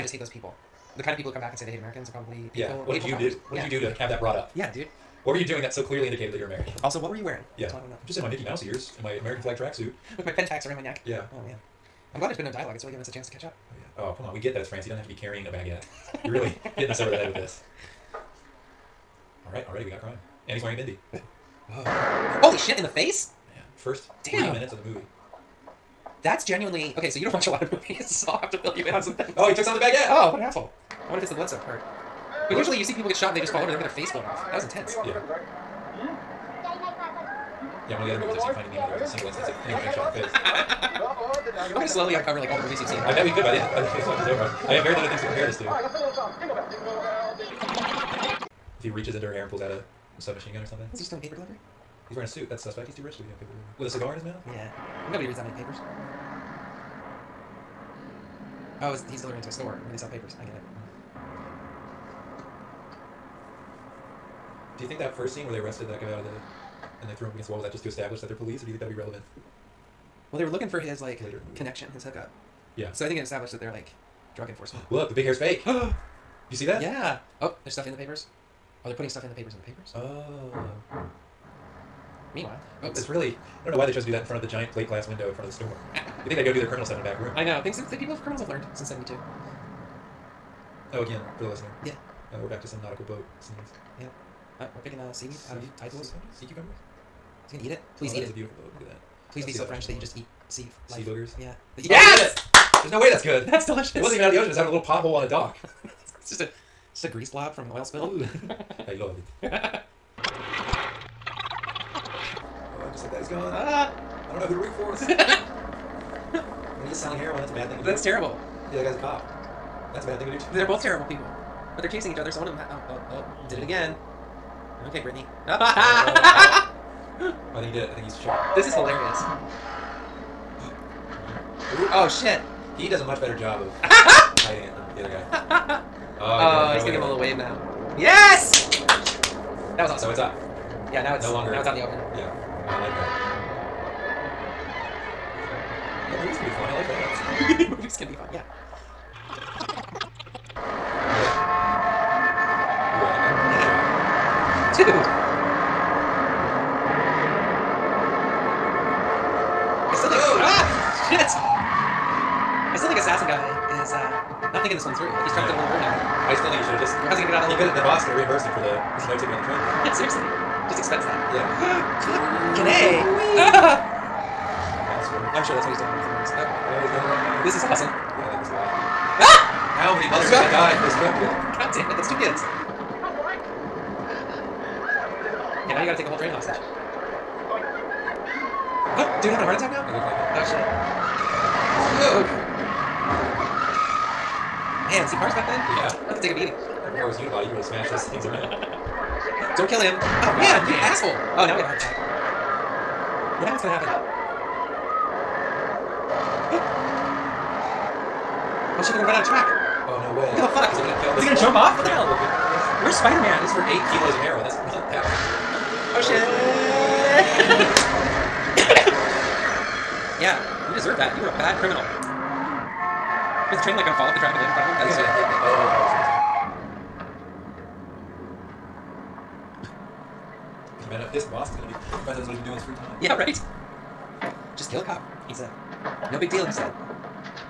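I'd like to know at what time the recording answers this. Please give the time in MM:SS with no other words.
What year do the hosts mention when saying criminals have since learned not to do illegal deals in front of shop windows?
01:28.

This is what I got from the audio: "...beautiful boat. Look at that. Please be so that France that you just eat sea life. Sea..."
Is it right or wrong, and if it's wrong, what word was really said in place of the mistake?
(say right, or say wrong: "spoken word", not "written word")
wrong: "French", not "France".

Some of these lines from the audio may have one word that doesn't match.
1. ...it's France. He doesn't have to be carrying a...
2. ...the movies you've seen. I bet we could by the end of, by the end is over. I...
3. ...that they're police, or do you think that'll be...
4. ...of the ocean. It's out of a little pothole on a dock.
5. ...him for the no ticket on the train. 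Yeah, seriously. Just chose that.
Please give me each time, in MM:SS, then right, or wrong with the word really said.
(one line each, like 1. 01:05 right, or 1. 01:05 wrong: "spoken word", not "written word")
1. 00:14 right
2. 00:42 right
3. 01:08 right
4. 01:44 right
5. 02:48 wrong: "expense", not "chose".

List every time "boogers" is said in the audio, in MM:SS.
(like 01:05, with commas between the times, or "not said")
01:41.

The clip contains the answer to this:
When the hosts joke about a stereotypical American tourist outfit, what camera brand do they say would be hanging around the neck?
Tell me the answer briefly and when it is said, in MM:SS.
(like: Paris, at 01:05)
Pentax, at 00:10.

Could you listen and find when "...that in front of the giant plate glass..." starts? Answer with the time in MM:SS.
01:24.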